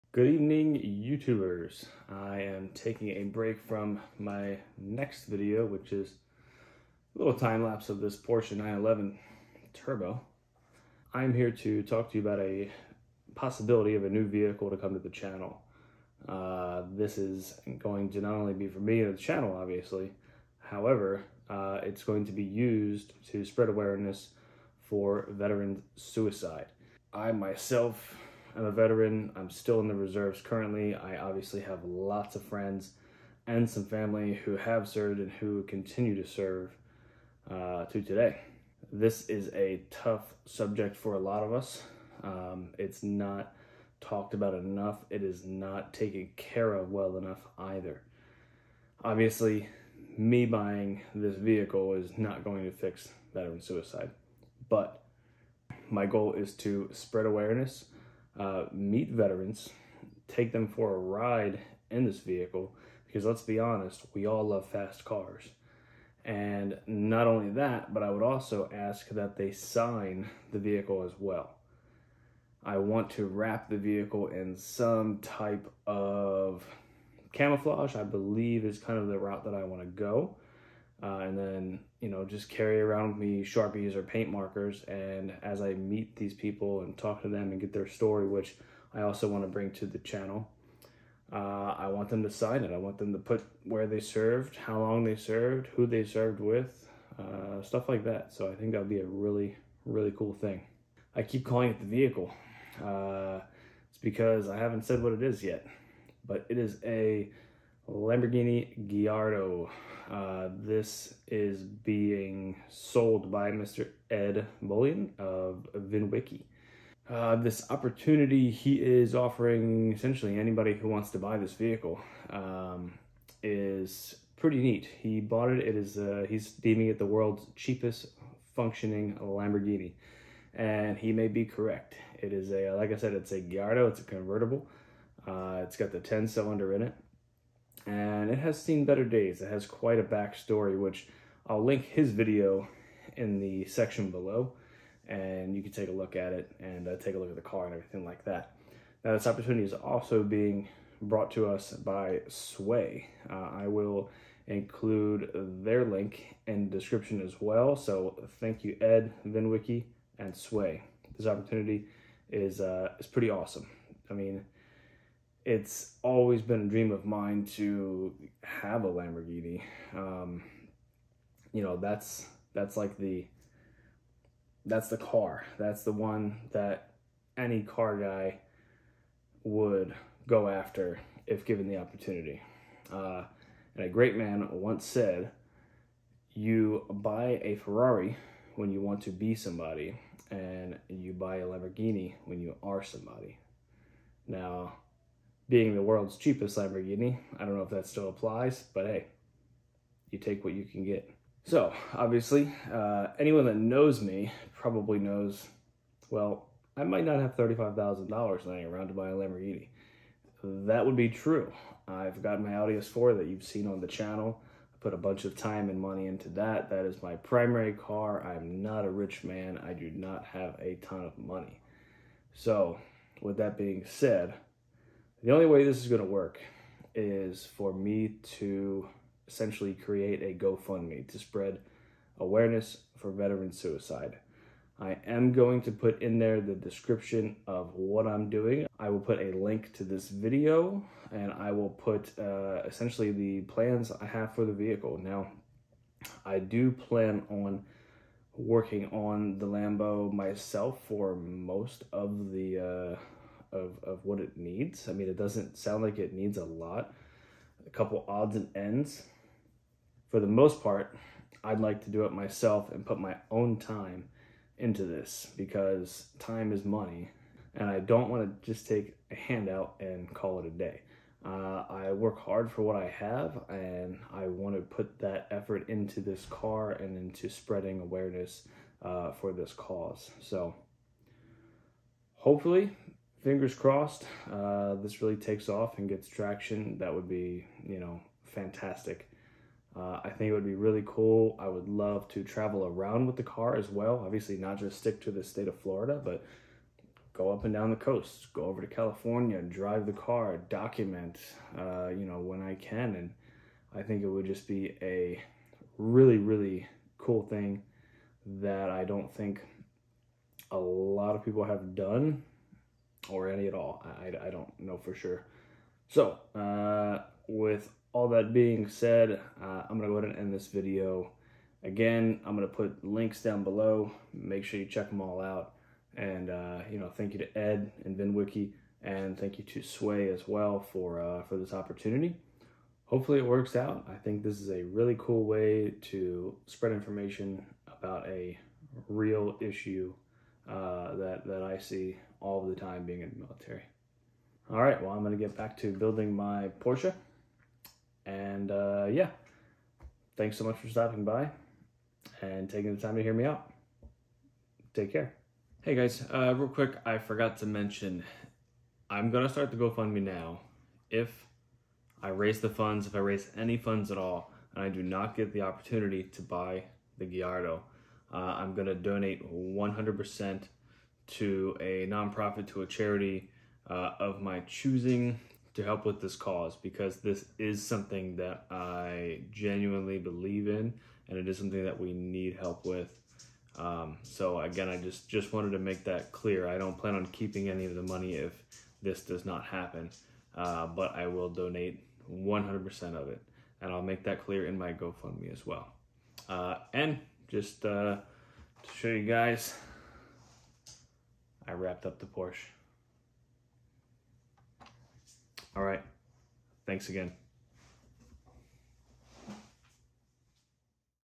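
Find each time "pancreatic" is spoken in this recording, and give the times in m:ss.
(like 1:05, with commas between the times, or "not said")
not said.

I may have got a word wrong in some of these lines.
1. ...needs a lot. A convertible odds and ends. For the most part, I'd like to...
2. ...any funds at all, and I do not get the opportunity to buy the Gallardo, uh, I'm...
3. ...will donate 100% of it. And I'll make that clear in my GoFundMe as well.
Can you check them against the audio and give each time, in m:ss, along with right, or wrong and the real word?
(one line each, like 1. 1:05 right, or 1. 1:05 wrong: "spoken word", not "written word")
1. 4:16 wrong: "couple", not "convertible"
2. 6:03 right
3. 6:31 right.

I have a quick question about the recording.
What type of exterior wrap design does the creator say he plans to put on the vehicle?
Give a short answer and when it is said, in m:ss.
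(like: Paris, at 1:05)
Camouflage, at 1:17.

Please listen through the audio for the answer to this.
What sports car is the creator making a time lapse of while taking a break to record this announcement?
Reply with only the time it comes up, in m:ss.
0:08.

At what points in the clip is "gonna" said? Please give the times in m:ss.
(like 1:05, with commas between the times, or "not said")
5:45, 5:59.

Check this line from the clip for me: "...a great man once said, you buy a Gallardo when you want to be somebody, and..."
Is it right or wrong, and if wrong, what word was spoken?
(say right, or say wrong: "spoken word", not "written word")
wrong: "Ferrari", not "Gallardo".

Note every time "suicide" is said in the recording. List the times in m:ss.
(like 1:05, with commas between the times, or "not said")
0:25, 0:53, 3:53.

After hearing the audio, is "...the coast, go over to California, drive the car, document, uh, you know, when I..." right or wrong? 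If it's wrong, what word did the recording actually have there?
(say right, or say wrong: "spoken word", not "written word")
right.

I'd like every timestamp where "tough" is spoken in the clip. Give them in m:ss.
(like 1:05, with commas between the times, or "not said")
0:39.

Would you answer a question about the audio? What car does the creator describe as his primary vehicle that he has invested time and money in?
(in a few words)
Audi S4.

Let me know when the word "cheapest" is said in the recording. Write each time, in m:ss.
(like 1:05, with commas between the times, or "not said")
2:07, 3:16.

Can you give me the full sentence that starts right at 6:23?
Um, so again, I just, just wanted to make that clear.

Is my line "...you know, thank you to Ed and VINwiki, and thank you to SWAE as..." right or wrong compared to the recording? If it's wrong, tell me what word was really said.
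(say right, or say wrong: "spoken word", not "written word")
right.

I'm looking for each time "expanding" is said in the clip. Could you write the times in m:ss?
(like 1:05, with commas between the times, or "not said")
not said.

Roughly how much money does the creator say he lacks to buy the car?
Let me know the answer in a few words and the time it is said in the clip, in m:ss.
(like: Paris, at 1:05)
$35,000, at 3:27.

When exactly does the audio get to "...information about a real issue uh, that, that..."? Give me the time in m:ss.
5:36.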